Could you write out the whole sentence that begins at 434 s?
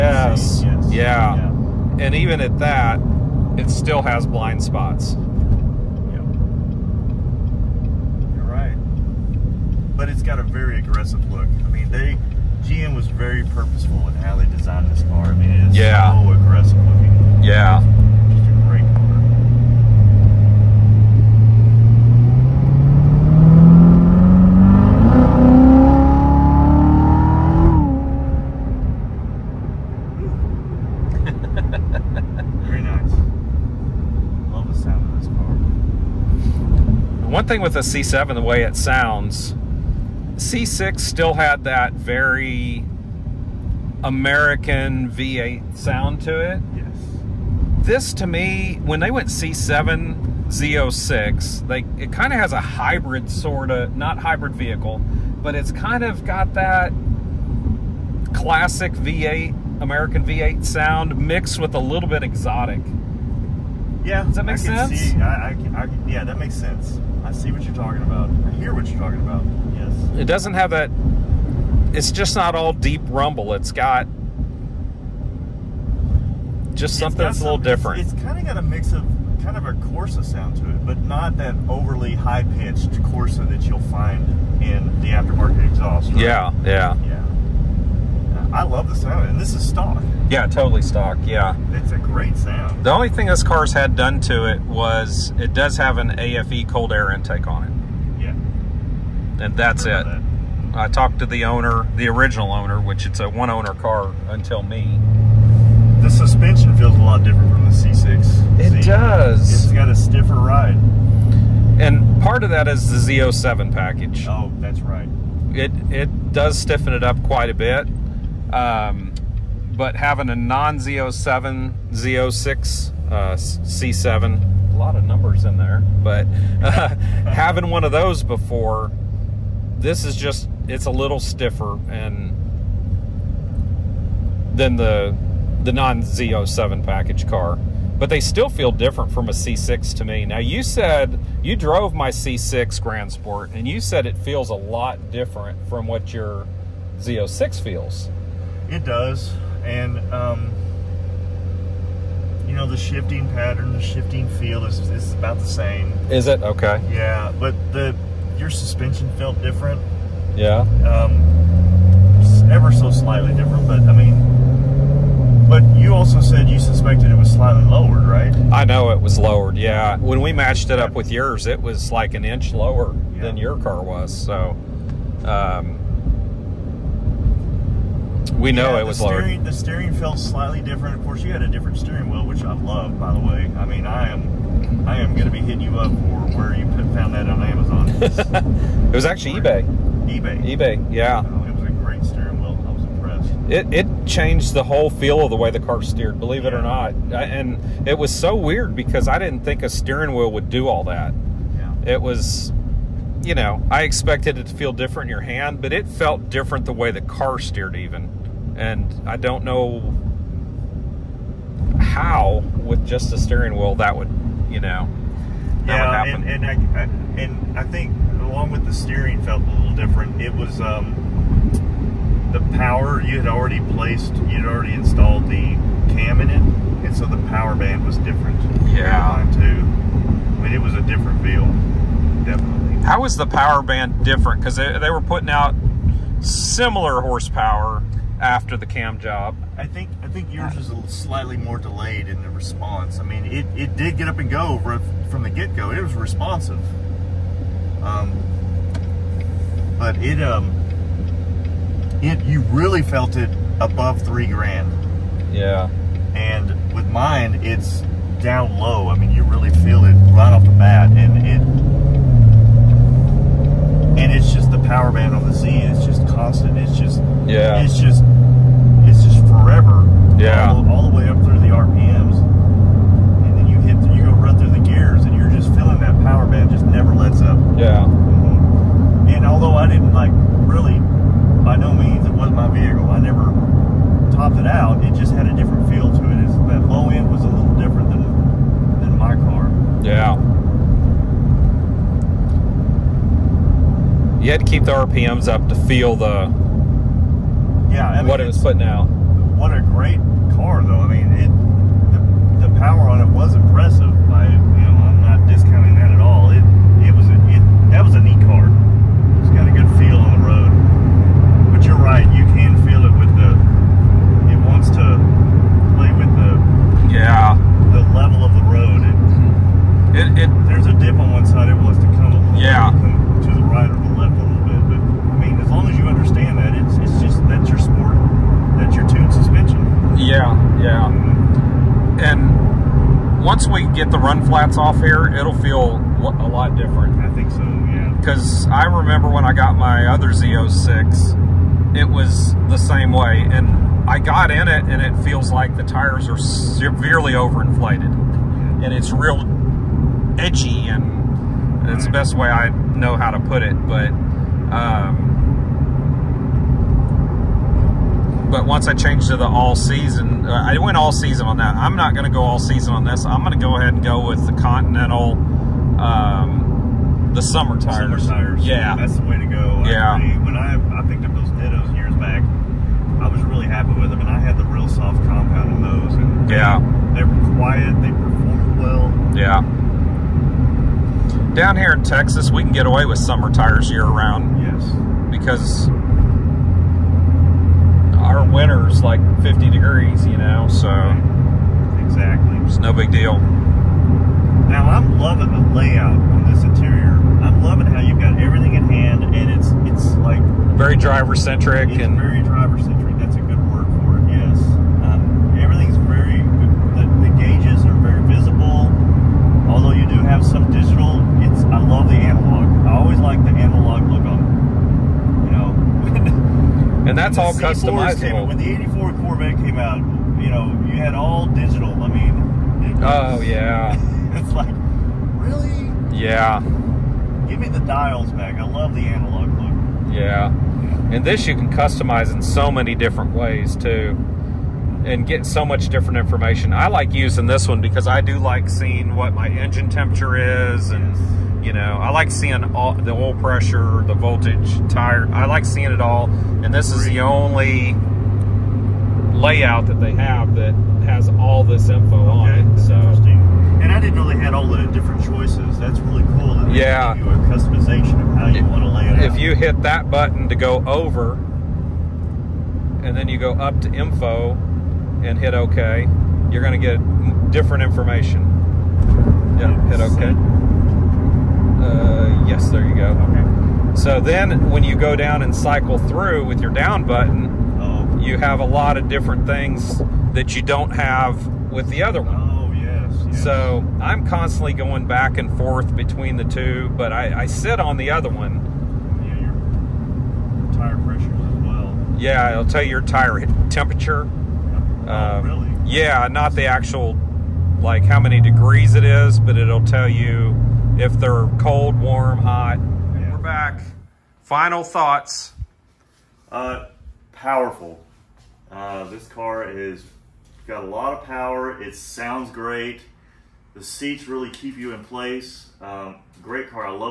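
And get so much different information.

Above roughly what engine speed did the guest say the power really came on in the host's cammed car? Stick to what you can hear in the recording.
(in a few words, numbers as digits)
3,000 RPM.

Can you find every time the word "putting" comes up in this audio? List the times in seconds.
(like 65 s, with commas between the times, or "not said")
235 s, 298 s.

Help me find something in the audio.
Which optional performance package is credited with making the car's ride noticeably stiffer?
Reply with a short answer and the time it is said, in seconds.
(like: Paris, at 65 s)
Z07, at 113 s.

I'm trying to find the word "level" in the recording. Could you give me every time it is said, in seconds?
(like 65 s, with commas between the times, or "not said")
317 s.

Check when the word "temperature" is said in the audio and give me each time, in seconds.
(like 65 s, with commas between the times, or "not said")
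439 s, 493 s.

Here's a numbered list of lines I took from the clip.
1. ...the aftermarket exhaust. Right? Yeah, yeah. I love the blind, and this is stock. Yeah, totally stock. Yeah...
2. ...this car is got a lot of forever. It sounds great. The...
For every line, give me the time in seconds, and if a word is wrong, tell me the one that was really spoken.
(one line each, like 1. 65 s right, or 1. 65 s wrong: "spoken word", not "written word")
1. 85 s wrong: "sound", not "blind"
2. 508 s wrong: "power", not "forever".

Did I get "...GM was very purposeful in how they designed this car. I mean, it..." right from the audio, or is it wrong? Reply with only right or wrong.
right.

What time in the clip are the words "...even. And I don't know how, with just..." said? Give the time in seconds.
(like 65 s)
207 s.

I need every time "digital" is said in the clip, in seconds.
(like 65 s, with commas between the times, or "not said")
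410 s, 421 s.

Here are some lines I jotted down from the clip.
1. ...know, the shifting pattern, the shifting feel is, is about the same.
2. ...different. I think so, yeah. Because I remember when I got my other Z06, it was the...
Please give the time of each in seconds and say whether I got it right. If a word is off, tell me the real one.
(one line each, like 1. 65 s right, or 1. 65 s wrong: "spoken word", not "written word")
1. 152 s right
2. 336 s right.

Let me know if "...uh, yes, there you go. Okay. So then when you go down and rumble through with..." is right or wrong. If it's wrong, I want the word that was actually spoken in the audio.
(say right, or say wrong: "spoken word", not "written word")
wrong: "cycle", not "rumble".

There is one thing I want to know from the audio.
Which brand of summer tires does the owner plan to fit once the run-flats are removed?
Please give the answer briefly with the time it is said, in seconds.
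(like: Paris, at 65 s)
Continental, at 364 s.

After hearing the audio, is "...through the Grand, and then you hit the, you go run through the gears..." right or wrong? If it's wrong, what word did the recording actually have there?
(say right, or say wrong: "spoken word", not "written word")
wrong: "RPMs", not "Grand".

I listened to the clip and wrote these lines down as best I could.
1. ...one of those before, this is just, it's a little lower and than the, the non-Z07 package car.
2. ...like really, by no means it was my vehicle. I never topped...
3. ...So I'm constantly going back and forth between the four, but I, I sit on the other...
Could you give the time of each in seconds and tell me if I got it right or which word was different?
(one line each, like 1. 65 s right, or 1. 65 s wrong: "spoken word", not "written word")
1. 127 s wrong: "stiffer", not "lower"
2. 279 s right
3. 483 s wrong: "two", not "four".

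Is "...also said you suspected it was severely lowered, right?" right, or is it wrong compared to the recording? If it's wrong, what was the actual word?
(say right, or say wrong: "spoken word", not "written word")
wrong: "slightly", not "severely".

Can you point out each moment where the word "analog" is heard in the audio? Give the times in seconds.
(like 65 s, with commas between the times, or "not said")
411 s, 428 s.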